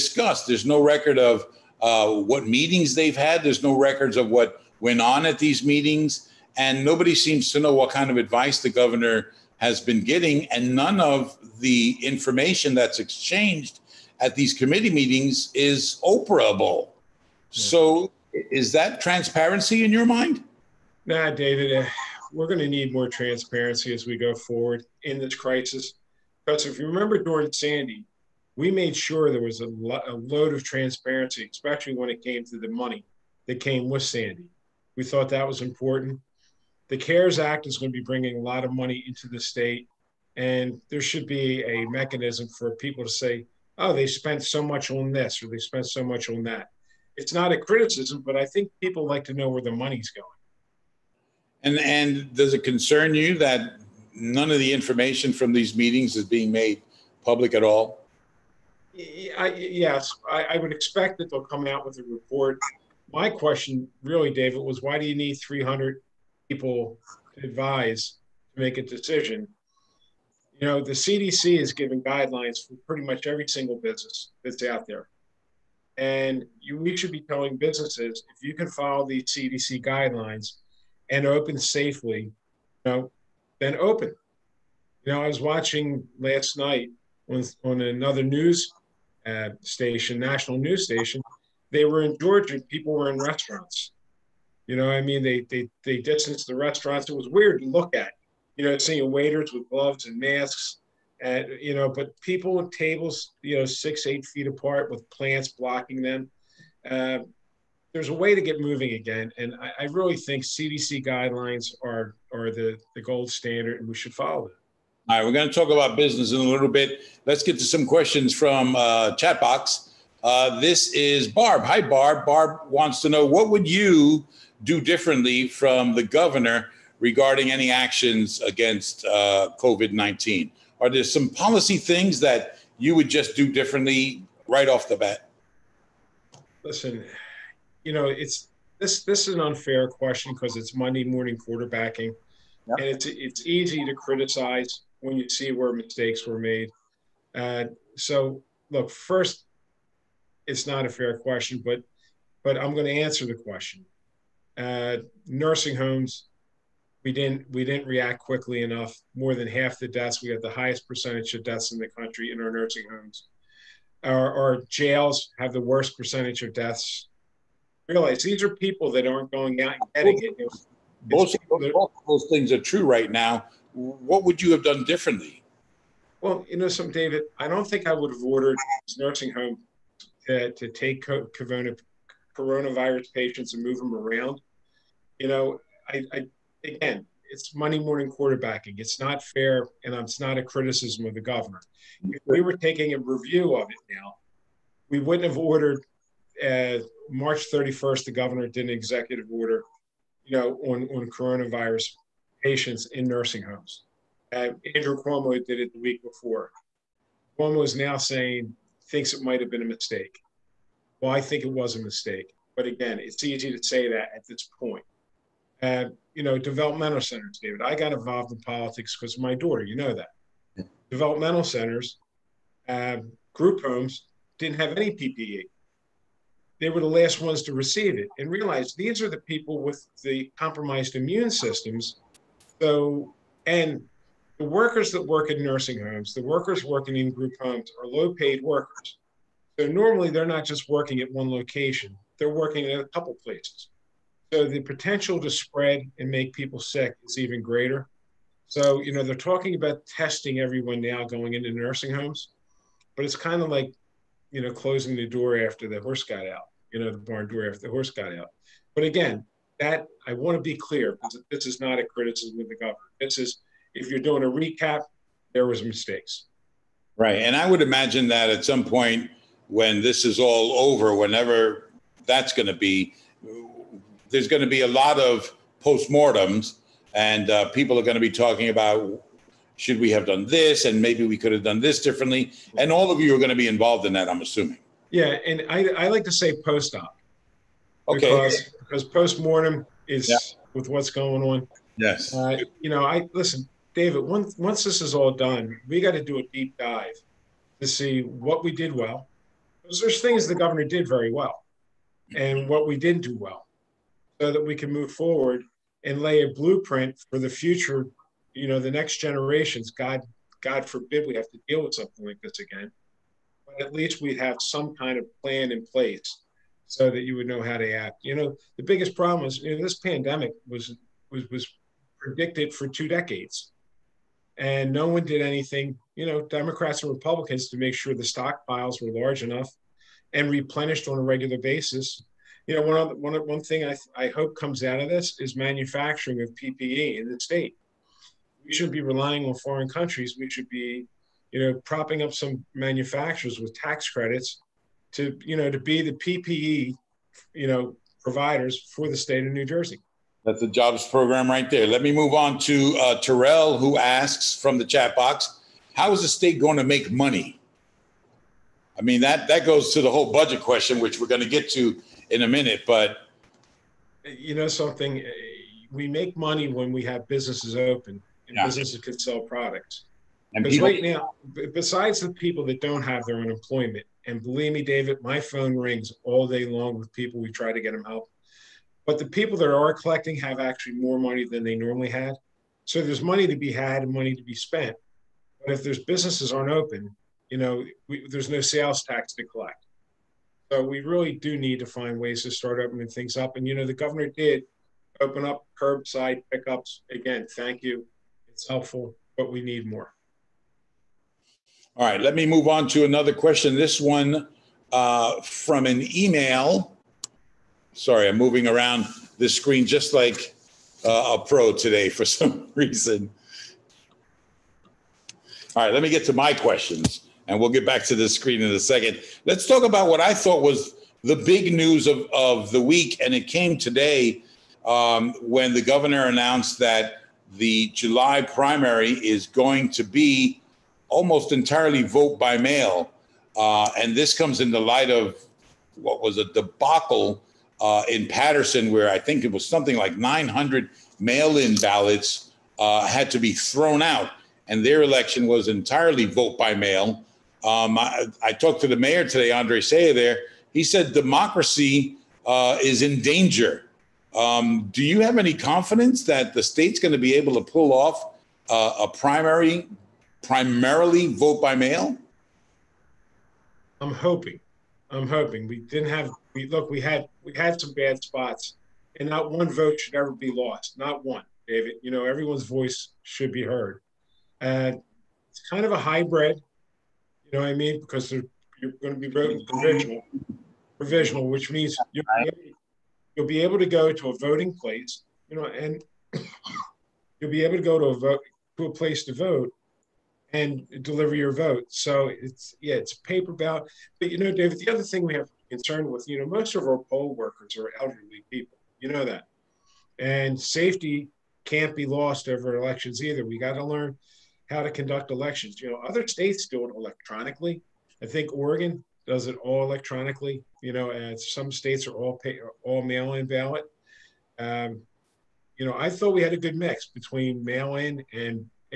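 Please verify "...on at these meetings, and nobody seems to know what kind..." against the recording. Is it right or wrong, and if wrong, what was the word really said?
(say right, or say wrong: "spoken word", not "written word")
right.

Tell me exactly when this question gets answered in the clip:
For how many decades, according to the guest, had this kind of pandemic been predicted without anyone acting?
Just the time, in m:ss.
5:22.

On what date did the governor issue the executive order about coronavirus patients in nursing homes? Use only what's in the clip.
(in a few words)
March 31st.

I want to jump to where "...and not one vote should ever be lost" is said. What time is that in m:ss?
7:48.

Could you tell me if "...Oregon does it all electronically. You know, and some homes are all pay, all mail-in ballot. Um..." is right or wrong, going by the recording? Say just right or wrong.
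wrong.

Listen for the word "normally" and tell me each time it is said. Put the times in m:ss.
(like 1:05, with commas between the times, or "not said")
3:59, 6:21.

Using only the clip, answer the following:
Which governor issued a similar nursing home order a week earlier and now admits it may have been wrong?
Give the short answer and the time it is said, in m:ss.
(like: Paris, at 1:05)
Andrew Cuomo, at 3:24.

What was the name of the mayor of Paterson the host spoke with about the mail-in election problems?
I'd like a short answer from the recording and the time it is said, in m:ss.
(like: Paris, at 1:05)
Andre Sayegh, at 7:29.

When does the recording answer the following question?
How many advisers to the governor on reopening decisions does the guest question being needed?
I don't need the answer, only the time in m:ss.
1:05.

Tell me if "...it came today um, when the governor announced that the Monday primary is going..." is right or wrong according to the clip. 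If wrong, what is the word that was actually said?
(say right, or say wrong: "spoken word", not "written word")
wrong: "July", not "Monday".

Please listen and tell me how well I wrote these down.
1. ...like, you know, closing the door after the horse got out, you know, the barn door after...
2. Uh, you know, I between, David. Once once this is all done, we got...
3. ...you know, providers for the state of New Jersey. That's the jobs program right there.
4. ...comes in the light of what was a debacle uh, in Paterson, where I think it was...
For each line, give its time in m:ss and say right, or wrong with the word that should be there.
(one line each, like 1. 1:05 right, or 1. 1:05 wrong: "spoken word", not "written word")
1. 4:13 right
2. 4:52 wrong: "listen", not "between"
3. 5:47 right
4. 7:14 right.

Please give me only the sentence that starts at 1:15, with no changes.
And you, we should be telling businesses if you can follow the CDC guidelines and open safely, you know, then open.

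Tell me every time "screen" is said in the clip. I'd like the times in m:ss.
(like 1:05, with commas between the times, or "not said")
6:49, 6:58.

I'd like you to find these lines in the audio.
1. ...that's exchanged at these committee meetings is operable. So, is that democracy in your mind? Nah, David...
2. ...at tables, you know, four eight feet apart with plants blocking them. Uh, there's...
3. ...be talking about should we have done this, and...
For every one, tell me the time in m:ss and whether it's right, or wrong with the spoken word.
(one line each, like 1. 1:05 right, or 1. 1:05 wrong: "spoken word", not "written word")
1. 0:12 wrong: "transparency", not "democracy"
2. 1:42 wrong: "six", not "four"
3. 4:38 right.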